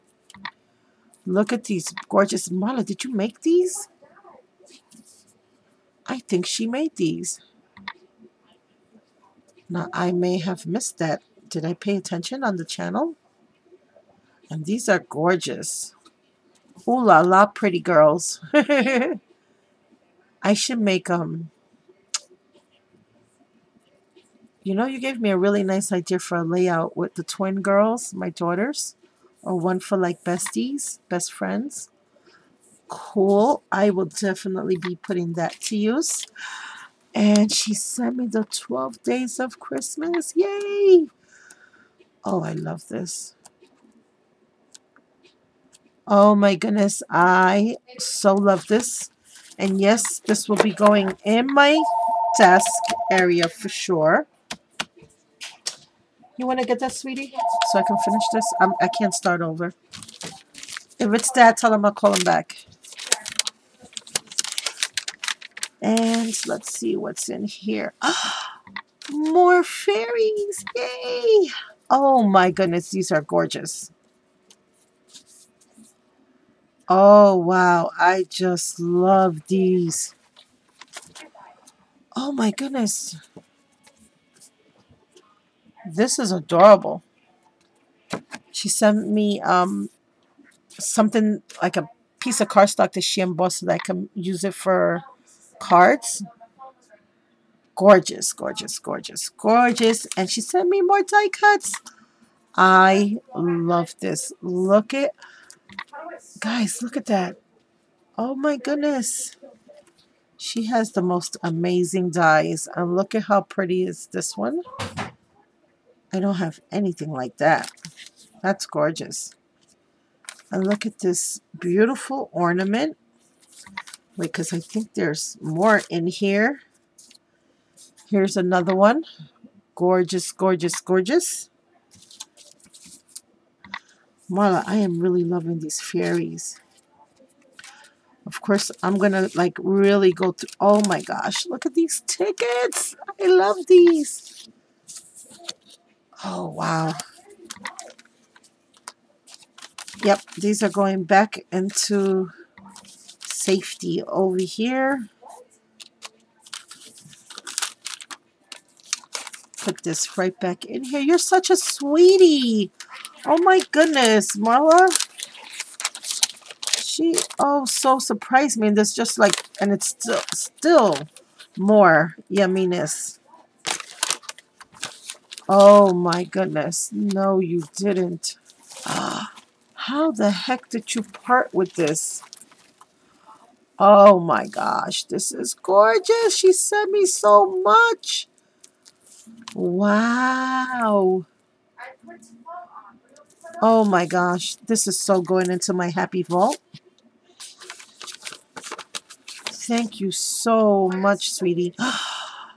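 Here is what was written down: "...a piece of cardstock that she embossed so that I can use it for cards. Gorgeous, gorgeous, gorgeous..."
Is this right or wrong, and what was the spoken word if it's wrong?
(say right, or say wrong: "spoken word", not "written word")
right.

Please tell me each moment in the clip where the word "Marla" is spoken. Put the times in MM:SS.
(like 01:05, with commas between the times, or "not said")
00:02, 02:14, 02:44.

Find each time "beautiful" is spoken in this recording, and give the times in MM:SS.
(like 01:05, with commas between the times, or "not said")
02:01.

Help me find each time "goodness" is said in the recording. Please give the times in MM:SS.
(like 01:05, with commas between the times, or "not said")
00:46, 01:12, 01:22, 01:48, 02:43, 02:56.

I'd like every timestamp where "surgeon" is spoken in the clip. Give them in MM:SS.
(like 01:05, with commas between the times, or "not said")
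not said.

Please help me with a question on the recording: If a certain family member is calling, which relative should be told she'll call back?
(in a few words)
Dad.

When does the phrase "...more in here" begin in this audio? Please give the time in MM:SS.
02:05.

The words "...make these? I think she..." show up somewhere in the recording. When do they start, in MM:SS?
00:03.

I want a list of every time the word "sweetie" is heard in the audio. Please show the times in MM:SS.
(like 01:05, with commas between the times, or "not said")
00:56, 02:41, 03:21.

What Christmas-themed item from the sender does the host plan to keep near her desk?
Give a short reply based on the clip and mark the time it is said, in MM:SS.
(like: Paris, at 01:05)
The 12 days of Christmas, at 00:38.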